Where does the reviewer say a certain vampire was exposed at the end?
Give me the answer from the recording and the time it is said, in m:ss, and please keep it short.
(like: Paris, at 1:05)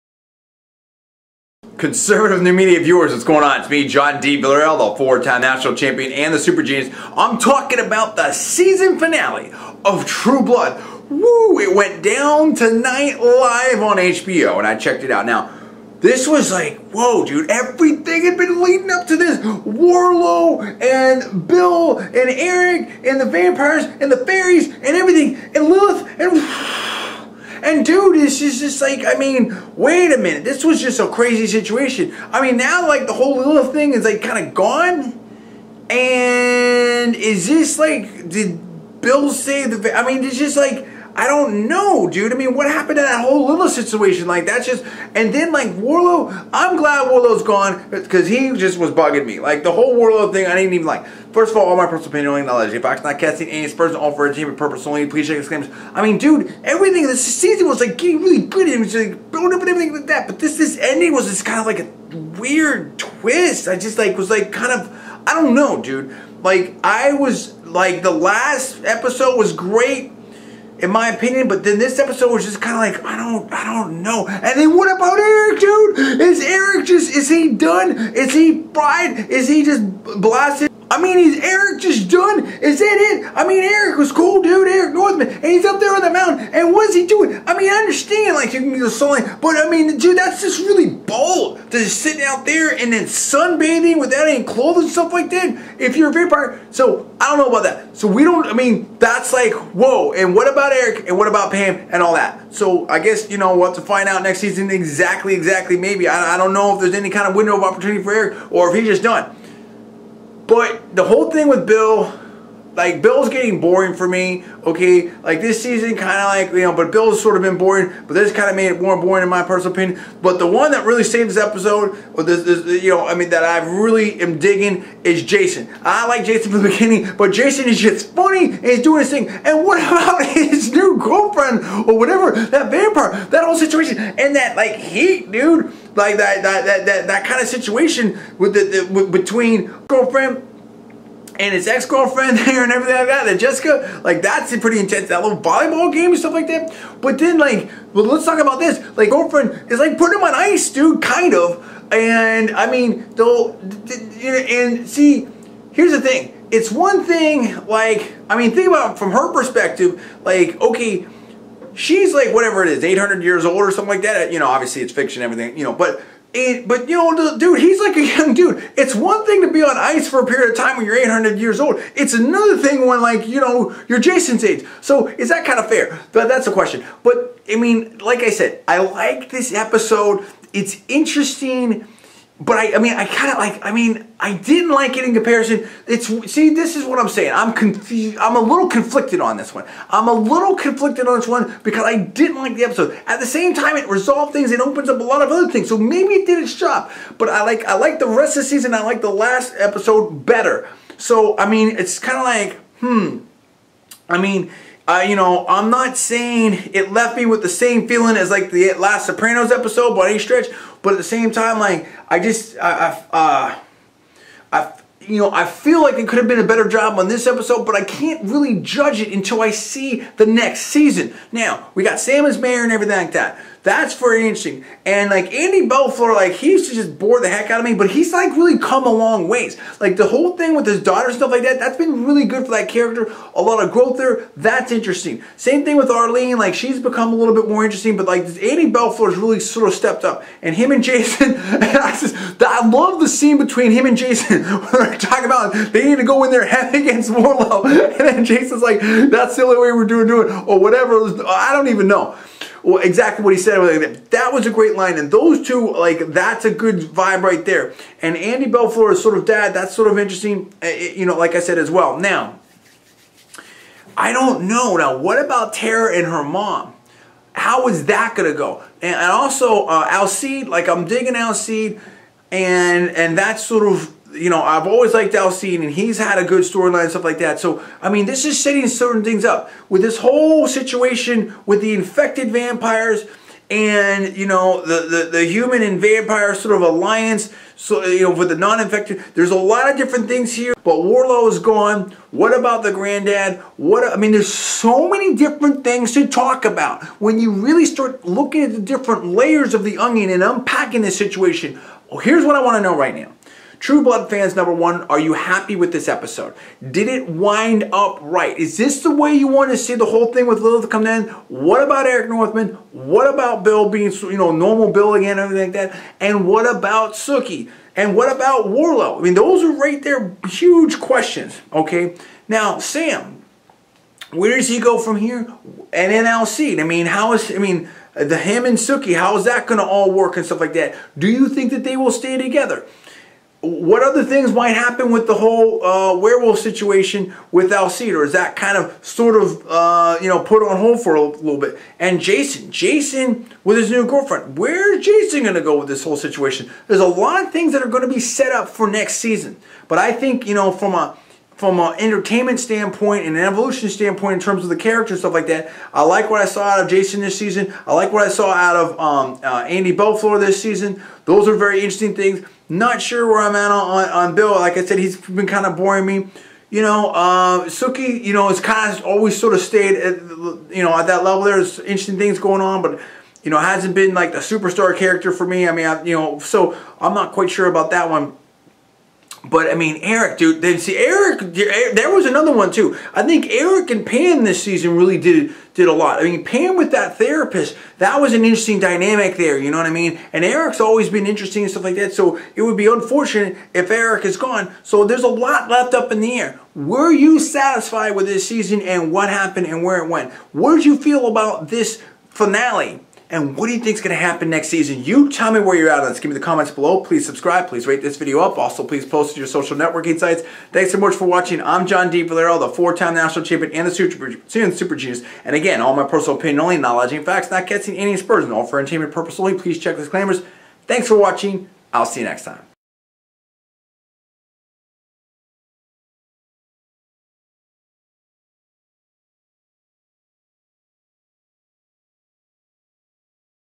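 the mountain, at 1:26.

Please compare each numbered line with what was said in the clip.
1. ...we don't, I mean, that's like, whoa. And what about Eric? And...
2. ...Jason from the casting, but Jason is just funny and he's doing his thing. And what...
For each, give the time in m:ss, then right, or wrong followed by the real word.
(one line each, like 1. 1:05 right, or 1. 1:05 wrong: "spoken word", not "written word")
1. 1:38 right
2. 2:06 wrong: "beginning", not "casting".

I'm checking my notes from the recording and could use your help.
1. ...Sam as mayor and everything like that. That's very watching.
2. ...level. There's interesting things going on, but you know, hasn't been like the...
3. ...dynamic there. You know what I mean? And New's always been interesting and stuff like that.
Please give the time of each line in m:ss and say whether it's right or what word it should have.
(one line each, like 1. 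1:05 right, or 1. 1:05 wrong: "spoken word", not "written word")
1. 3:41 wrong: "interesting", not "watching"
2. 6:11 right
3. 6:28 wrong: "Eric", not "New".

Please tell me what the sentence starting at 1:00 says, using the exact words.
But this this ending was just kind of like a weird twist.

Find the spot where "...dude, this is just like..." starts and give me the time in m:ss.
0:27.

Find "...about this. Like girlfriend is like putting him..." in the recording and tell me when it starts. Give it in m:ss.
2:28.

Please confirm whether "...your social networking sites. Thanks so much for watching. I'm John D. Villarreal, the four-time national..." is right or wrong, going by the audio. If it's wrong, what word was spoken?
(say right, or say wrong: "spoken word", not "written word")
right.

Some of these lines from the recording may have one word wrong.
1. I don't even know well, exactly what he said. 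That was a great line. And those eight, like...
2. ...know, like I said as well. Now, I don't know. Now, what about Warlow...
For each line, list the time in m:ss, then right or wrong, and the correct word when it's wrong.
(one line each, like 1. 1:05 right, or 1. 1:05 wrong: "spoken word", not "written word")
1. 4:11 wrong: "two", not "eight"
2. 4:21 wrong: "Tara", not "Warlow".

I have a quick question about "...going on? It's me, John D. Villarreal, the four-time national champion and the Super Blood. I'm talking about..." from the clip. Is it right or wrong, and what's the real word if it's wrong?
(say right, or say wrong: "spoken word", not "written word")
wrong: "Genius", not "Blood".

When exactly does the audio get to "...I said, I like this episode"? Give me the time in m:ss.
2:58.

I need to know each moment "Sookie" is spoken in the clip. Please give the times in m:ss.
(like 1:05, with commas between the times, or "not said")
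5:16, 5:28, 6:07.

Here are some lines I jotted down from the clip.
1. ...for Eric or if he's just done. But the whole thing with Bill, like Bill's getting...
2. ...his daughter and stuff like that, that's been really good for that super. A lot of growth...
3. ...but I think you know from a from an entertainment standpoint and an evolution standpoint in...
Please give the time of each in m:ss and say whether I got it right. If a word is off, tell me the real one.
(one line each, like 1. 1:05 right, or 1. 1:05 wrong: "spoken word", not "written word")
1. 1:48 right
2. 3:50 wrong: "character", not "super"
3. 5:49 right.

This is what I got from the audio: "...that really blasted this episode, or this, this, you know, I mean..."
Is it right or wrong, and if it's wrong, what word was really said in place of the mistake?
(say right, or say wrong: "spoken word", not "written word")
wrong: "saved", not "blasted".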